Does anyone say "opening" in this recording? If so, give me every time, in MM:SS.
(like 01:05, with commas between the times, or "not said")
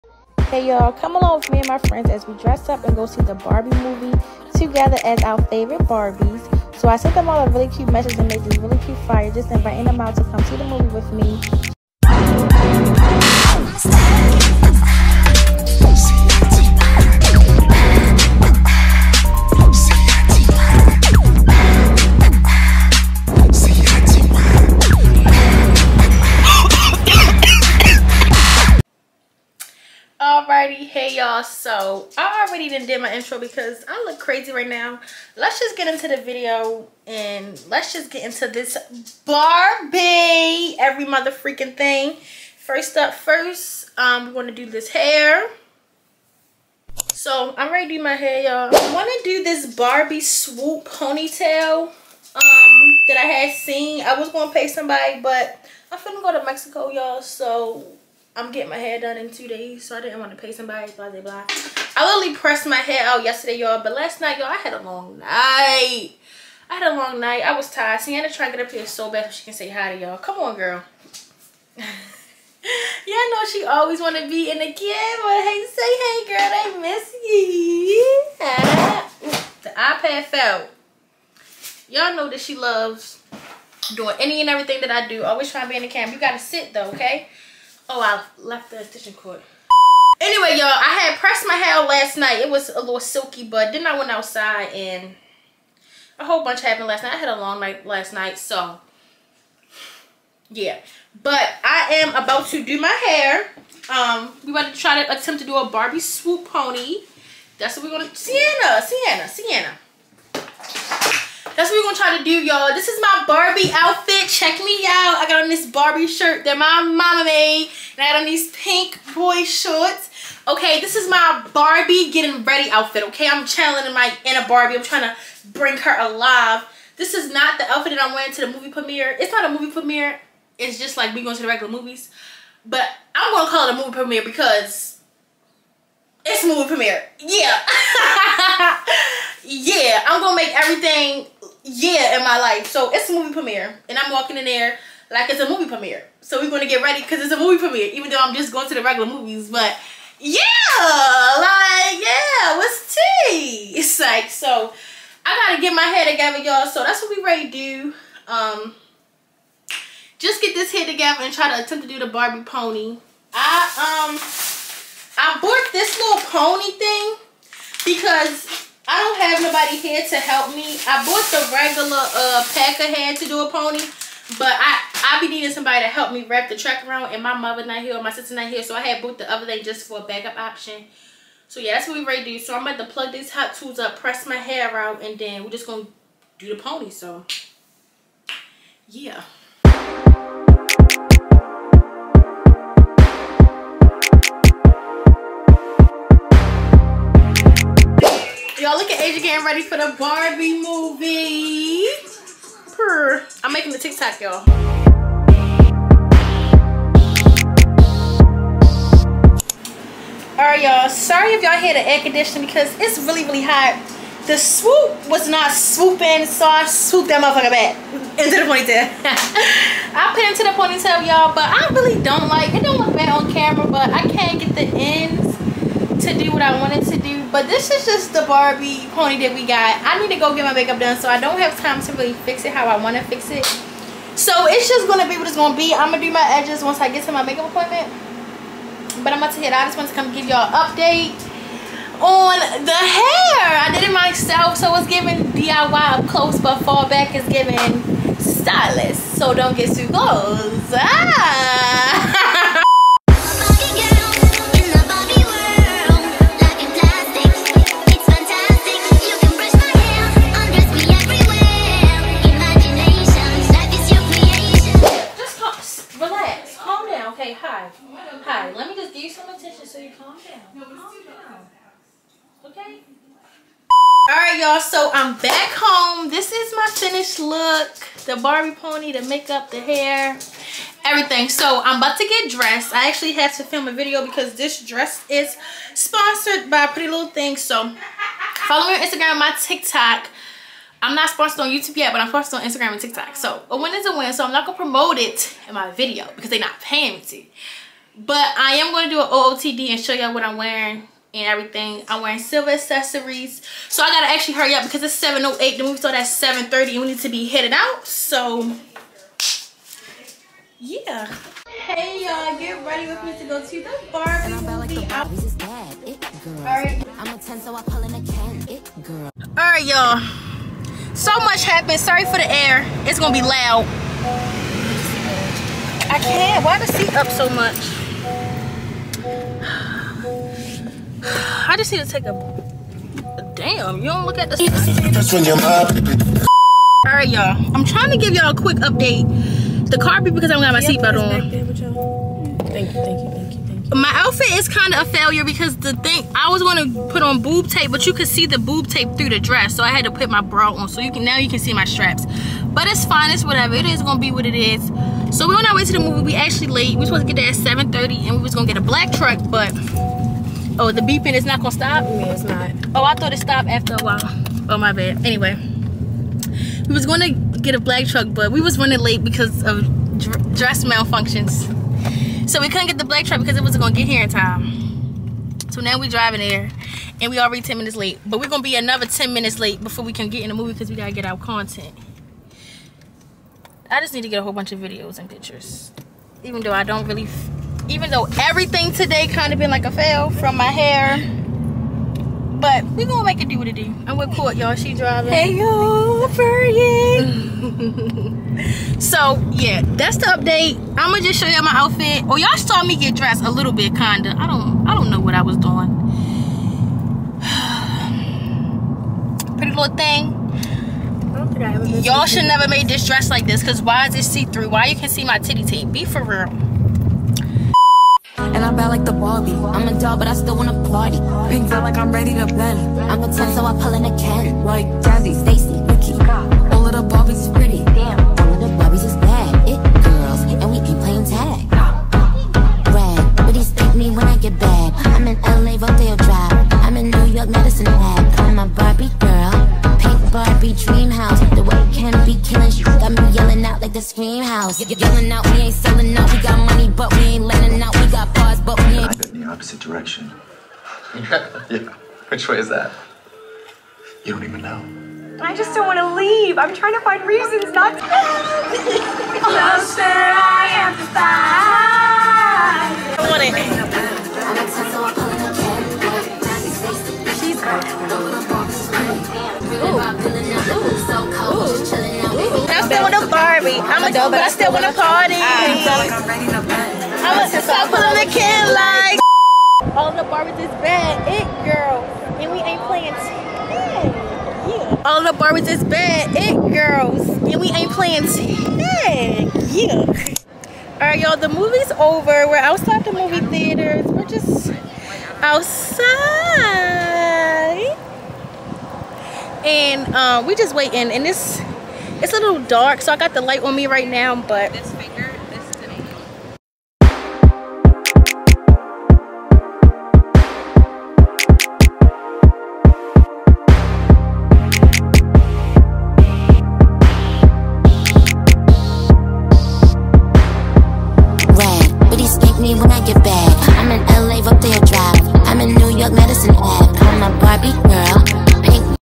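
not said.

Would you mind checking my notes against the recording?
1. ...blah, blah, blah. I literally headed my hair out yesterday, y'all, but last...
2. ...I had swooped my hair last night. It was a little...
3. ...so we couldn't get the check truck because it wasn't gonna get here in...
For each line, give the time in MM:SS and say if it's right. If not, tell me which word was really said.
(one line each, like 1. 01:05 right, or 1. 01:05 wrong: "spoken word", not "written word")
1. 01:00 wrong: "pressed", not "headed"
2. 01:30 wrong: "pressed", not "swooped"
3. 06:12 wrong: "black", not "check".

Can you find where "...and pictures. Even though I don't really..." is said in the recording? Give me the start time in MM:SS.
06:24.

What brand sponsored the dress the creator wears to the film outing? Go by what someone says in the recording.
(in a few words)
Pretty Little Things.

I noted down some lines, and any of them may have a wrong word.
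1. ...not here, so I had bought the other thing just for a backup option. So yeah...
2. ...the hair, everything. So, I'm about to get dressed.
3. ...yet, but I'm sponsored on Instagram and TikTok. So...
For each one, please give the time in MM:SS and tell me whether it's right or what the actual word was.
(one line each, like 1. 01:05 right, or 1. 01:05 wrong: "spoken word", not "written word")
1. 02:58 right
2. 04:39 right
3. 04:51 right.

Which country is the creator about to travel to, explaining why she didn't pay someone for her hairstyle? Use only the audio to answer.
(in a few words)
Mexico.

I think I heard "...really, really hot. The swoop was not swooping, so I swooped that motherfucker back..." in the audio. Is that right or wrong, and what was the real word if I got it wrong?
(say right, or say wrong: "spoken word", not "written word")
right.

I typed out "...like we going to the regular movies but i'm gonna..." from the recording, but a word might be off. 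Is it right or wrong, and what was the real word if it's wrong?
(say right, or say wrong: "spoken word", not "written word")
right.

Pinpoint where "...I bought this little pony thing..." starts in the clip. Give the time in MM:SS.
02:45.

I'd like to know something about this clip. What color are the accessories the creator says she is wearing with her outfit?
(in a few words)
Silver.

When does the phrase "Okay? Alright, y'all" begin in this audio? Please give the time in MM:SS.
04:32.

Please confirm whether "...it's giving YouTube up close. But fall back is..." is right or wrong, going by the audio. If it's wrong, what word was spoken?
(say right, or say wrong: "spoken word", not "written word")
wrong: "DIY", not "YouTube".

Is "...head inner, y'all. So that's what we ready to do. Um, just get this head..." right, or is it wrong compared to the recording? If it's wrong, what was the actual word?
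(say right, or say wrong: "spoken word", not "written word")
wrong: "together", not "inner".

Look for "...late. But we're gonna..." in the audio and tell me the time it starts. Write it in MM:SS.
06:17.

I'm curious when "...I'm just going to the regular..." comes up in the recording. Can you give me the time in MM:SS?
02:28.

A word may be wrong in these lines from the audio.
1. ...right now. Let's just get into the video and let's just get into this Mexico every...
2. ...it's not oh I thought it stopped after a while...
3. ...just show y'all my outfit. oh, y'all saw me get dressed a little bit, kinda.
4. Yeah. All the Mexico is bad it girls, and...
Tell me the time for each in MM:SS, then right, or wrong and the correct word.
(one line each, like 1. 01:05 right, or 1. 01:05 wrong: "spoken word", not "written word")
1. 00:34 wrong: "Barbie", not "Mexico"
2. 06:02 right
3. 06:40 right
4. 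08:02 wrong: "Barbies", not "Mexico".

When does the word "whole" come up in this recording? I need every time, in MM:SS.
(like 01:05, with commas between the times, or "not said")
01:36, 06:24.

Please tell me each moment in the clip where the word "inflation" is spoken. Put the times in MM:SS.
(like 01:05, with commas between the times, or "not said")
not said.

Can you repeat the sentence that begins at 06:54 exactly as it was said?
Why you can see my titty tape?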